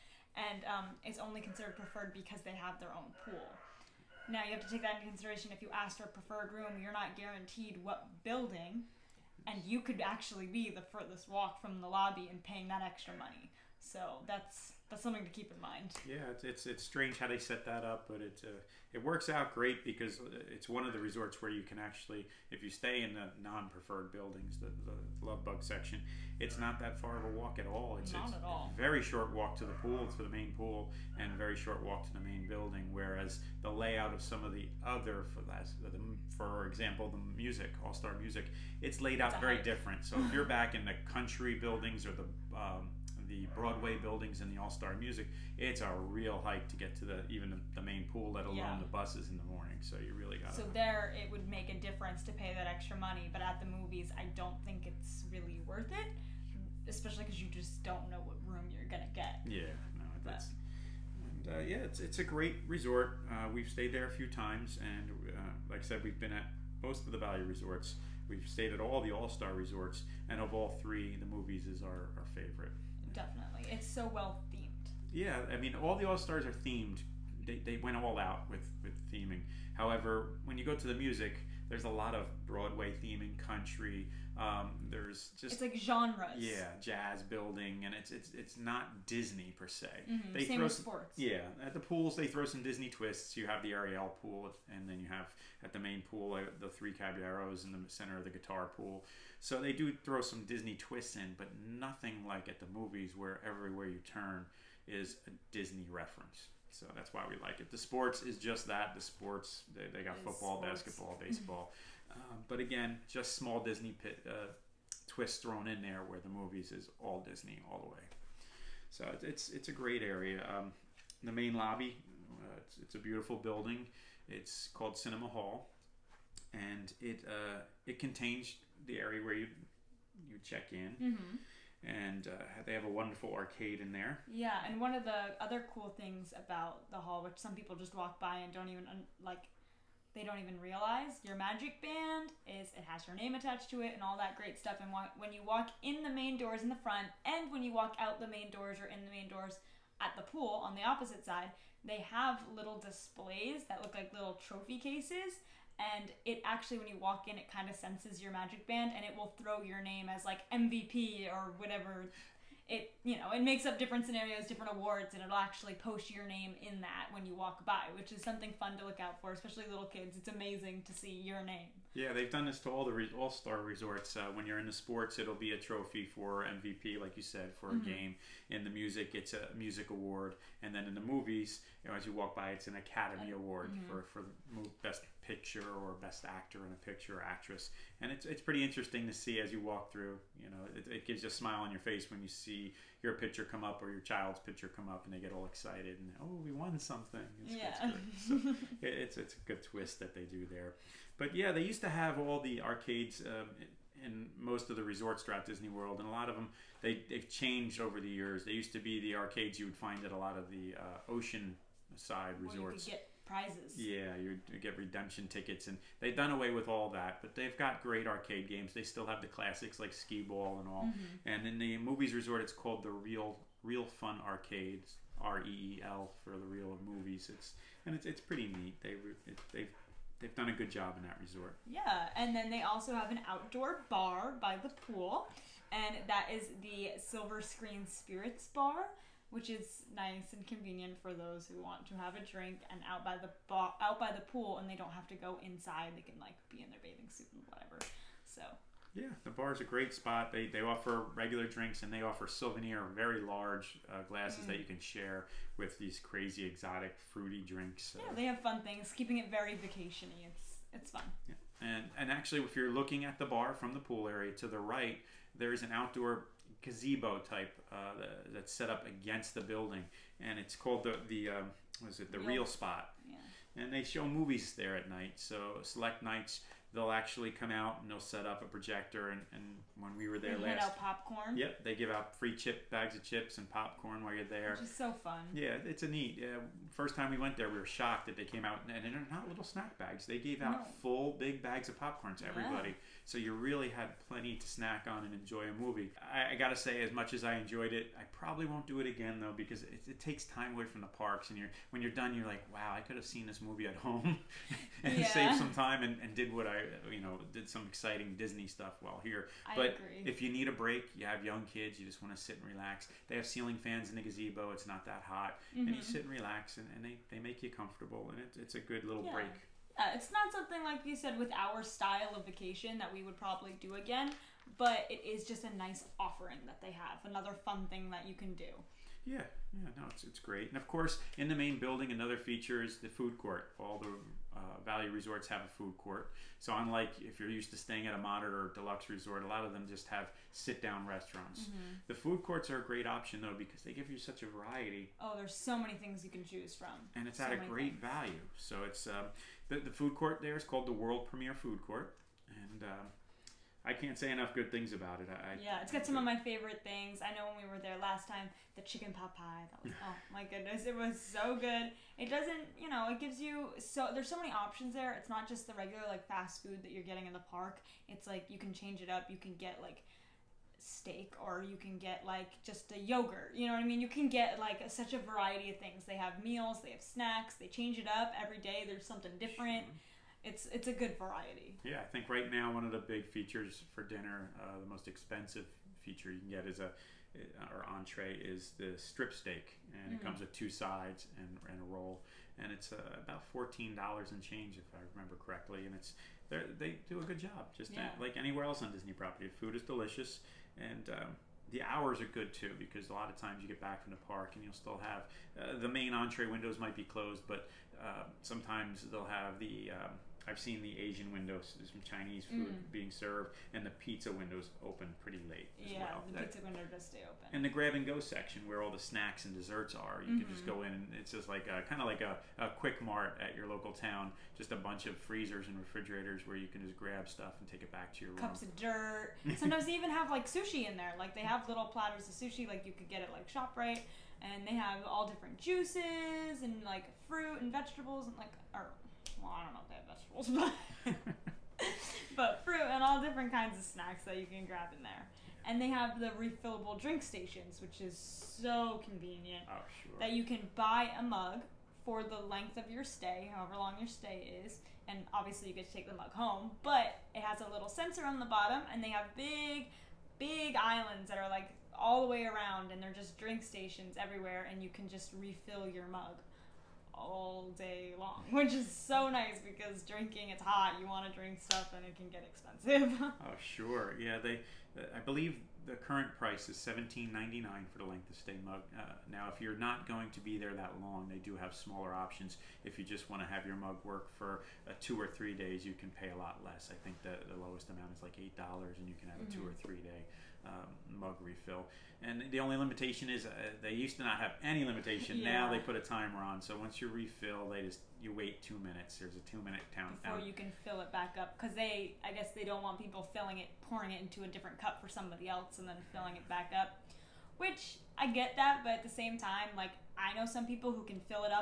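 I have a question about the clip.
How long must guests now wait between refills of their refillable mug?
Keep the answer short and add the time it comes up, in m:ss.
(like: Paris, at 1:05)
2 minutes, at 8:18.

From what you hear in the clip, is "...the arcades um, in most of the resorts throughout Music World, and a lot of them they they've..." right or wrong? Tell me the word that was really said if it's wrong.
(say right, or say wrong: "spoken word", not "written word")
wrong: "Disney", not "Music".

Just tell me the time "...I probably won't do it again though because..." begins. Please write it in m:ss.
4:57.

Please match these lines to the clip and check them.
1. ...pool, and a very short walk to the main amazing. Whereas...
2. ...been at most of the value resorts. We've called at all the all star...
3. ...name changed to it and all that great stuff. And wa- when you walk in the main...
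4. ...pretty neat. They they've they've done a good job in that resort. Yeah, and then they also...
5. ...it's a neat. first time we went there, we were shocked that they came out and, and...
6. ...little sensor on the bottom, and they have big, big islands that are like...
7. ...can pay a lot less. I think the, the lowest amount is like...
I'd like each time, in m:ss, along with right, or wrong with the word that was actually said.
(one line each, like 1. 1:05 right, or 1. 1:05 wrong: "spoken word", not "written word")
1. 0:30 wrong: "building", not "amazing"
2. 1:06 wrong: "stayed", not "called"
3. 2:23 wrong: "attached", not "changed"
4. 3:48 right
5. 4:45 right
6. 7:37 right
7. 8:05 right.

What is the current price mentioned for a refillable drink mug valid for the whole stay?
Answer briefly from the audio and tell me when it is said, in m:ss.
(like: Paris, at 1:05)
$17.99, at 7:56.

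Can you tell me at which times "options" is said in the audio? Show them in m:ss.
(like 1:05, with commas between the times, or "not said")
5:42, 6:04, 8:01.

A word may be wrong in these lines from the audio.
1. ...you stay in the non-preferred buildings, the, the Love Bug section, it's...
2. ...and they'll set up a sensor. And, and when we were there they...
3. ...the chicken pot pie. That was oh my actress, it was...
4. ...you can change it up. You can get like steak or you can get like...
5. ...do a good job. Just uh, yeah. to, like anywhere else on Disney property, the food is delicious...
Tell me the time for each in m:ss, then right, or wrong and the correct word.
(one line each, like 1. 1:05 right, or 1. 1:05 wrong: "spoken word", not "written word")
1. 0:22 right
2. 4:37 wrong: "projector", not "sensor"
3. 5:58 wrong: "goodness", not "actress"
4. 6:08 right
5. 6:36 right.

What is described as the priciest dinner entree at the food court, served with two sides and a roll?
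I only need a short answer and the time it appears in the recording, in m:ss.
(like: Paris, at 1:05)
Strip steak, at 6:28.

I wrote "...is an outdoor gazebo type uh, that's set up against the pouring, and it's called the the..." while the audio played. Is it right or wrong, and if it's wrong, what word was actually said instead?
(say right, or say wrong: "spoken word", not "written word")
wrong: "building", not "pouring".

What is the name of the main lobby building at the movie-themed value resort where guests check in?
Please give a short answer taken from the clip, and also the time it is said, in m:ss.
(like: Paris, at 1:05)
Cinema Hall, at 2:04.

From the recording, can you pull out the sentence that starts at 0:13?
So that's that's something to keep in mind.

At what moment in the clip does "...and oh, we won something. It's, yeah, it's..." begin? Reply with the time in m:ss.
3:15.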